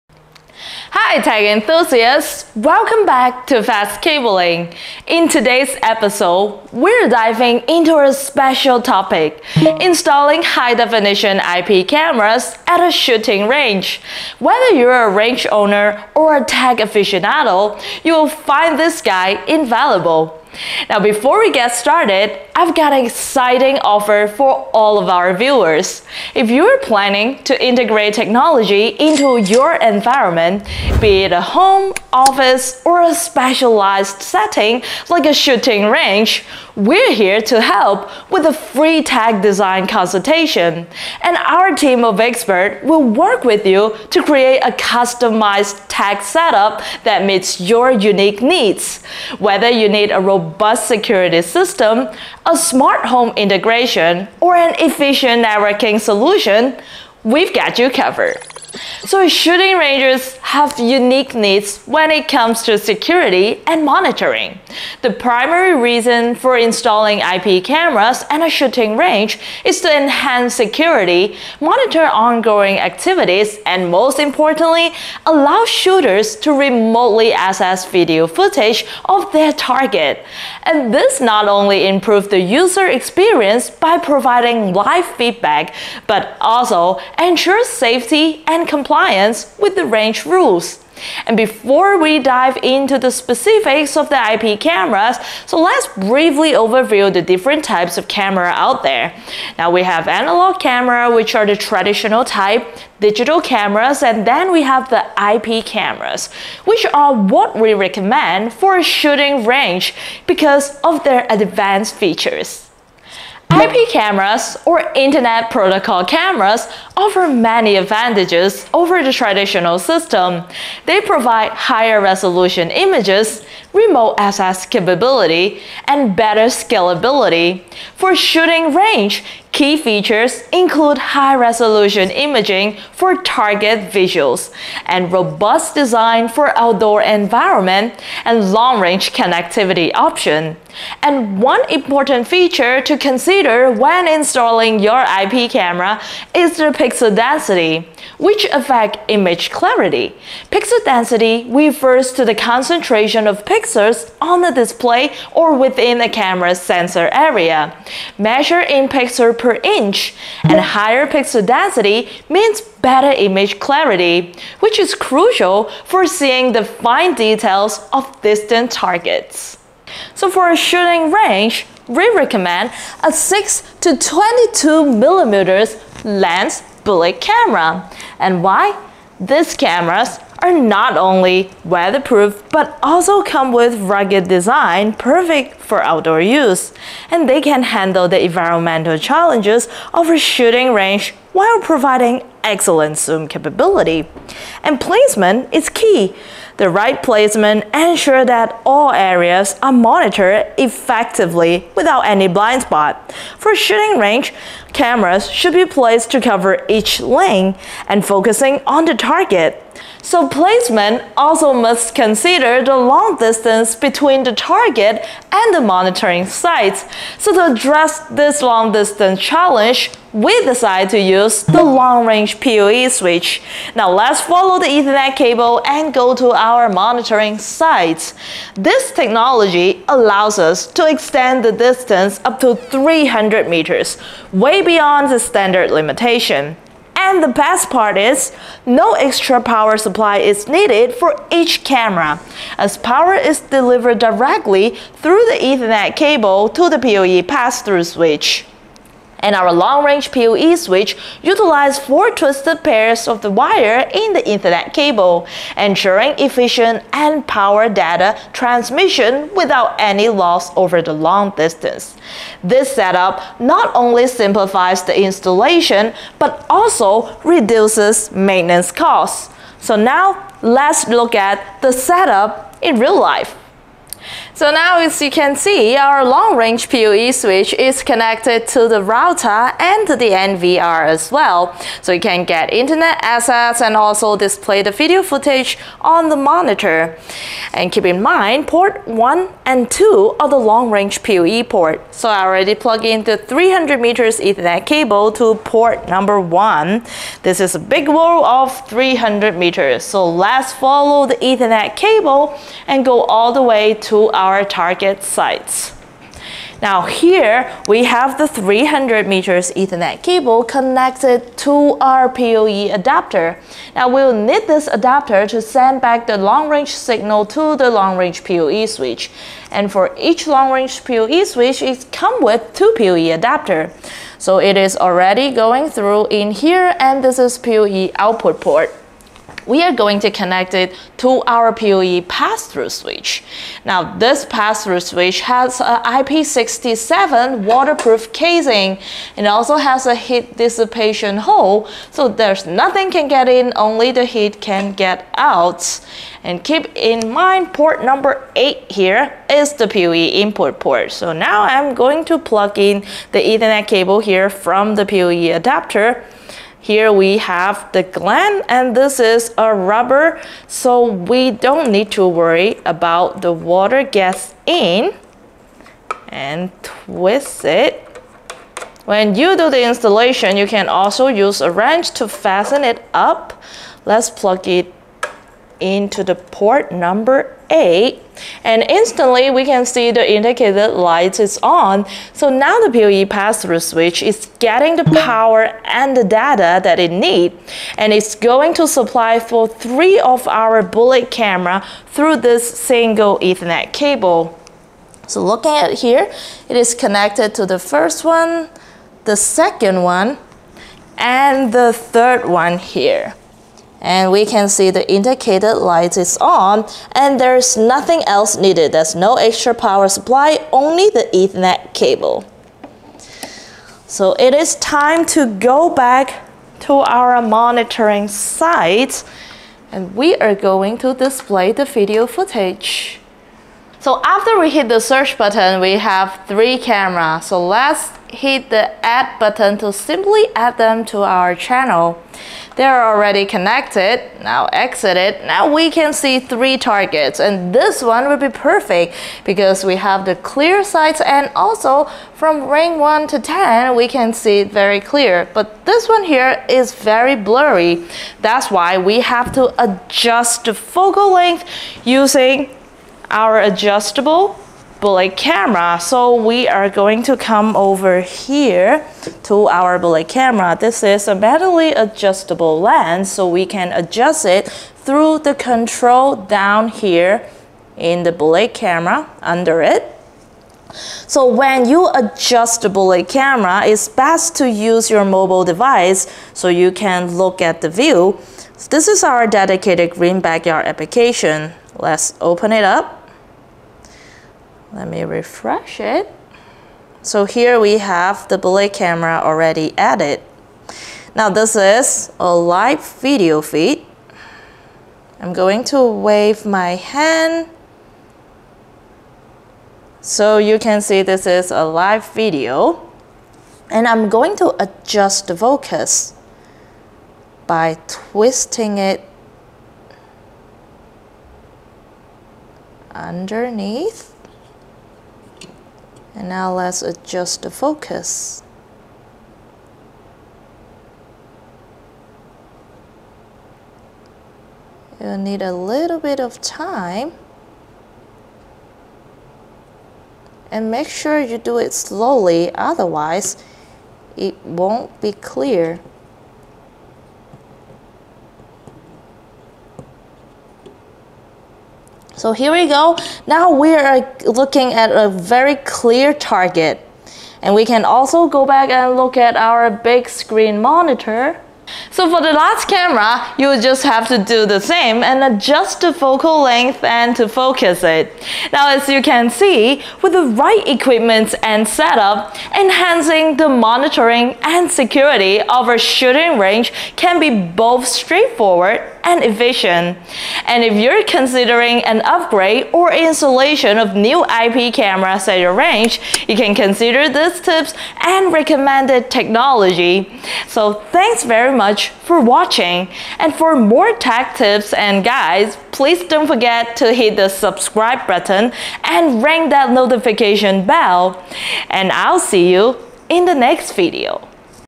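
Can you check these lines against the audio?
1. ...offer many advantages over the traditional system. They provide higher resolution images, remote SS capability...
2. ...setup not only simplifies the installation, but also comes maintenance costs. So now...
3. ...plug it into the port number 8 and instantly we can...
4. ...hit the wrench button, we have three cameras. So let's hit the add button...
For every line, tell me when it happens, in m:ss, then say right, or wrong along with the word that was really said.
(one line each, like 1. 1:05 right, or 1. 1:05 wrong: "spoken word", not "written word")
1. 1:56 right
2. 4:22 wrong: "reduces", not "comes"
3. 6:14 right
4. 7:04 wrong: "search", not "wrench".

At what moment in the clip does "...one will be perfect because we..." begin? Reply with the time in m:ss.
7:17.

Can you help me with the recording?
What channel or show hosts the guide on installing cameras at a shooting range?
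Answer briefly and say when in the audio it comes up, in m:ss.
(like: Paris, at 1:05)
Fast Cabling, at 0:03.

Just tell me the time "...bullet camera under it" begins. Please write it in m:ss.
7:48.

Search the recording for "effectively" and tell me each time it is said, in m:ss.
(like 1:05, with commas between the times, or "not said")
3:20.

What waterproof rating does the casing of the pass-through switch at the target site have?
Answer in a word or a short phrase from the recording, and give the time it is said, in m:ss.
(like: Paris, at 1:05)
IP67, at 5:35.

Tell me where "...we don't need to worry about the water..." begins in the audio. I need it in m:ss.
6:00.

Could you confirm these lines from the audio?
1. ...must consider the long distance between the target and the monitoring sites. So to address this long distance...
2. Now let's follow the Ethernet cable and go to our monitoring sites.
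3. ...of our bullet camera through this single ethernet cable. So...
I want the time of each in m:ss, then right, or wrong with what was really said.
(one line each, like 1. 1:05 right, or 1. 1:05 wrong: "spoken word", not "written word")
1. 3:31 right
2. 3:43 right
3. 6:29 right.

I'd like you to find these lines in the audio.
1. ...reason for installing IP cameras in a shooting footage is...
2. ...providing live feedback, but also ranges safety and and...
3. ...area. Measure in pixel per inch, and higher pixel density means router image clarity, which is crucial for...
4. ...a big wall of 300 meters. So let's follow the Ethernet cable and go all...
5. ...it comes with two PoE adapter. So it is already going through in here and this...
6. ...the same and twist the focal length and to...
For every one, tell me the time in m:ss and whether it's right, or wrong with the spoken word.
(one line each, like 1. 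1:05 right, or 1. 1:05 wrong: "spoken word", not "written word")
1. 1:05 wrong: "range", not "footage"
2. 1:23 wrong: "ensures", not "ranges"
3. 2:37 wrong: "better", not "router"
4. 4:57 right
5. 5:21 right
6. 9:14 wrong: "adjust", not "twist".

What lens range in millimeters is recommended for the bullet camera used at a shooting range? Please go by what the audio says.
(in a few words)
6 to 22 millimeters.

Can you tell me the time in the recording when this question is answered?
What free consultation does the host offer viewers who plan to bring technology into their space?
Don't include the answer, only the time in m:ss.
0:39.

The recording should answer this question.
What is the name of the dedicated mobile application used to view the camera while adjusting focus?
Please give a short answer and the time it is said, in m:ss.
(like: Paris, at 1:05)
green backyard, at 7:59.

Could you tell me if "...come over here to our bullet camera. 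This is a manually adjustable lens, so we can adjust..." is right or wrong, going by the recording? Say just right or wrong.
right.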